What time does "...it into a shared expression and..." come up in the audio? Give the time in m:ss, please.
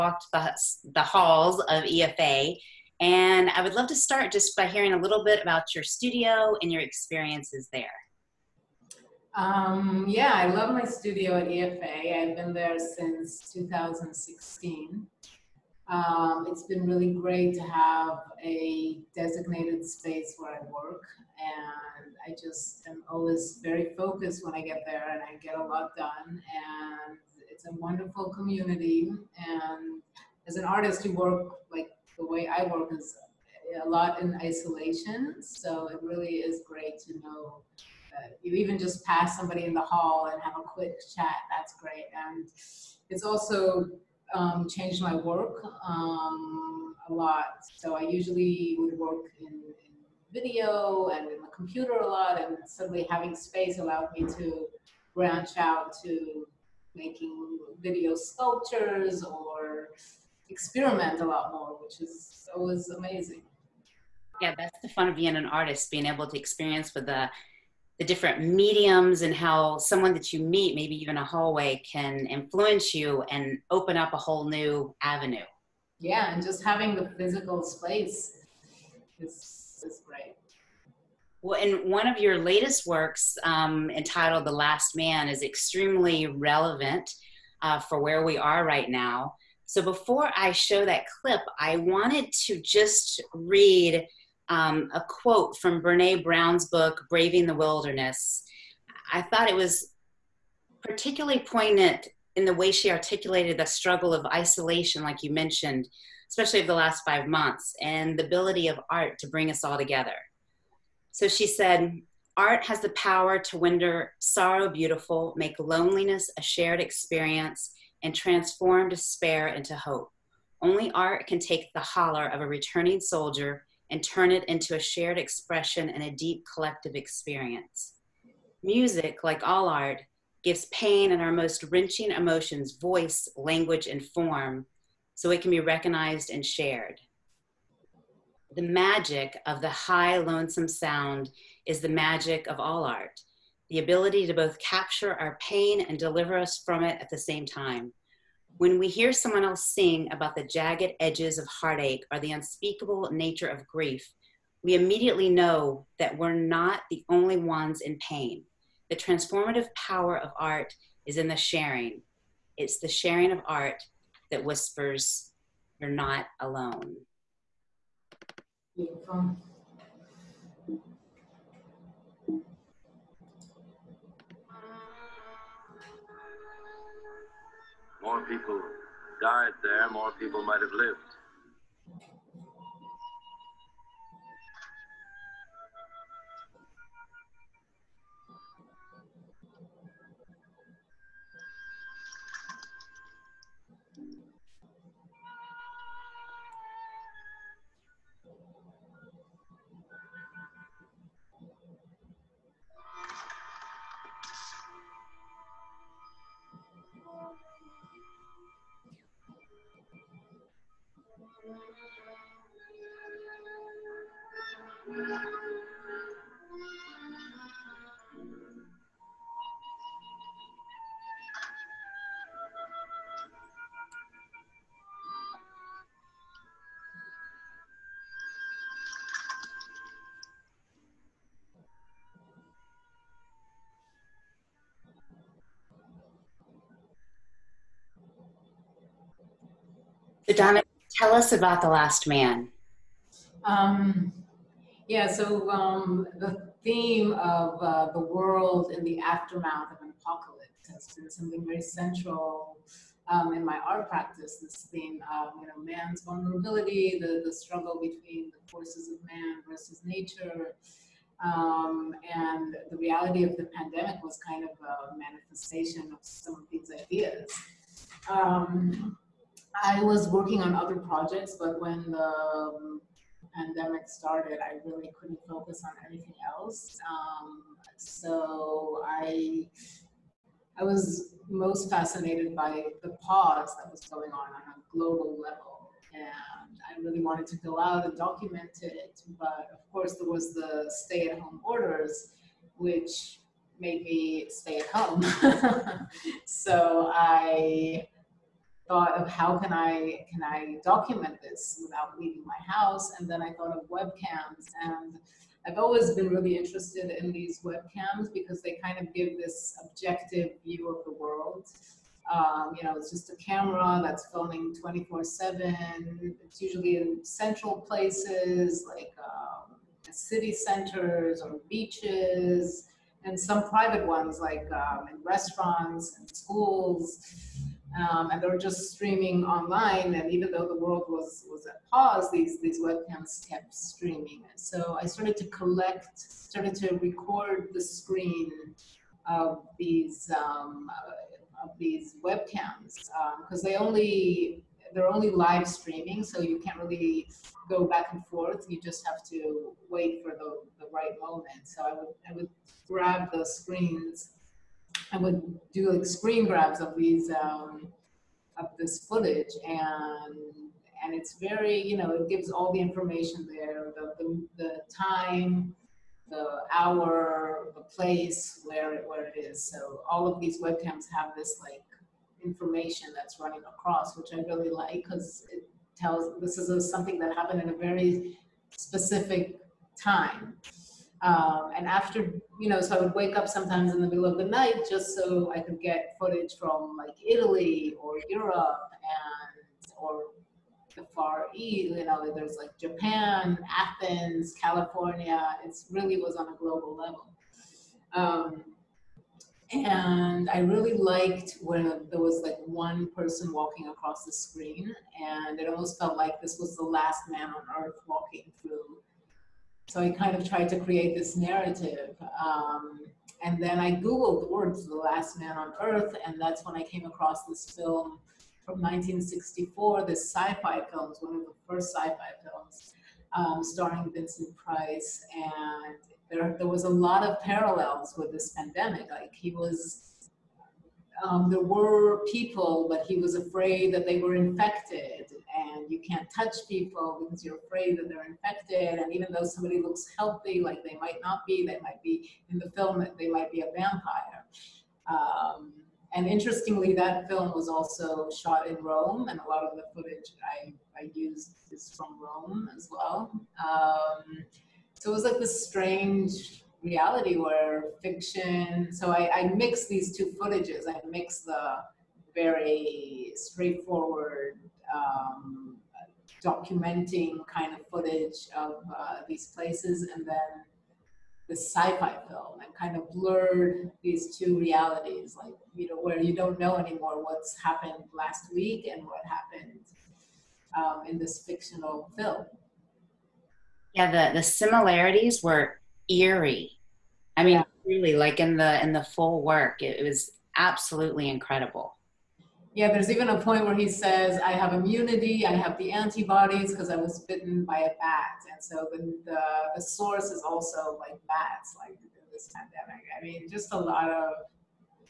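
2:04.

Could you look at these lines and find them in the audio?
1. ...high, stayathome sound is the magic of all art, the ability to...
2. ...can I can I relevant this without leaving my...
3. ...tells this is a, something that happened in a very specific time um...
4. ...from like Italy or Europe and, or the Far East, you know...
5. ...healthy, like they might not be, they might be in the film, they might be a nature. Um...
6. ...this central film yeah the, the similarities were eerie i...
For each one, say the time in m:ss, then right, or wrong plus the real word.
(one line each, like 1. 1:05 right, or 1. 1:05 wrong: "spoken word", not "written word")
1. 2:19 wrong: "lonesome", not "stayathome"
2. 4:59 wrong: "document", not "relevant"
3. 6:15 right
4. 6:26 right
5. 7:19 wrong: "vampire", not "nature"
6. 8:00 wrong: "fictional", not "central".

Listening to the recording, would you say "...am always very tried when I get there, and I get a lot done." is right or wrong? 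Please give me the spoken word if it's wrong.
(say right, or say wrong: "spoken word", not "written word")
wrong: "focused", not "tried".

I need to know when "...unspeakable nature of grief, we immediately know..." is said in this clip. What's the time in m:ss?
2:32.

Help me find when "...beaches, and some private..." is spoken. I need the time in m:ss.
5:21.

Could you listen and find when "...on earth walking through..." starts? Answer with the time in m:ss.
6:47.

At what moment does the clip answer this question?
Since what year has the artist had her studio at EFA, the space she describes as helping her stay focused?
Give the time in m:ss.
0:13.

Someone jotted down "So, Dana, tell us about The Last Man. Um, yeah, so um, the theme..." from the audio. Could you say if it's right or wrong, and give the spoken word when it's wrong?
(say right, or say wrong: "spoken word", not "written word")
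right.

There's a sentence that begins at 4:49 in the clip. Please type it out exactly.
But of course, there was the stay-at-home orders, which made me stay at home.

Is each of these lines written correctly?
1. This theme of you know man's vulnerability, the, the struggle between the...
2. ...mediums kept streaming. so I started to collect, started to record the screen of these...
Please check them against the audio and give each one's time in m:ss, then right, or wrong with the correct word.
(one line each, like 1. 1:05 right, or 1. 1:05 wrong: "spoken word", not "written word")
1. 4:14 right
2. 5:32 wrong: "webcams", not "mediums".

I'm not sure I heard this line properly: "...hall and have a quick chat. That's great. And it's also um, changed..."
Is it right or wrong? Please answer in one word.
right.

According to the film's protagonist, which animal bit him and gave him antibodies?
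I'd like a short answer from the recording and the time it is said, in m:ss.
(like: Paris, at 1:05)
A bat, at 8:17.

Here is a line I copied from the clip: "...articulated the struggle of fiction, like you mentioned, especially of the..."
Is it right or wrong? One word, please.
wrong.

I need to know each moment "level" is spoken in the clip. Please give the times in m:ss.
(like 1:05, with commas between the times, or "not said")
4:45, 6:36.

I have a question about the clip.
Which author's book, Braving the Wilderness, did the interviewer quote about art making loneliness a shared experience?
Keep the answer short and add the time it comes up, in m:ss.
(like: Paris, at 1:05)
Brene Brown, at 1:35.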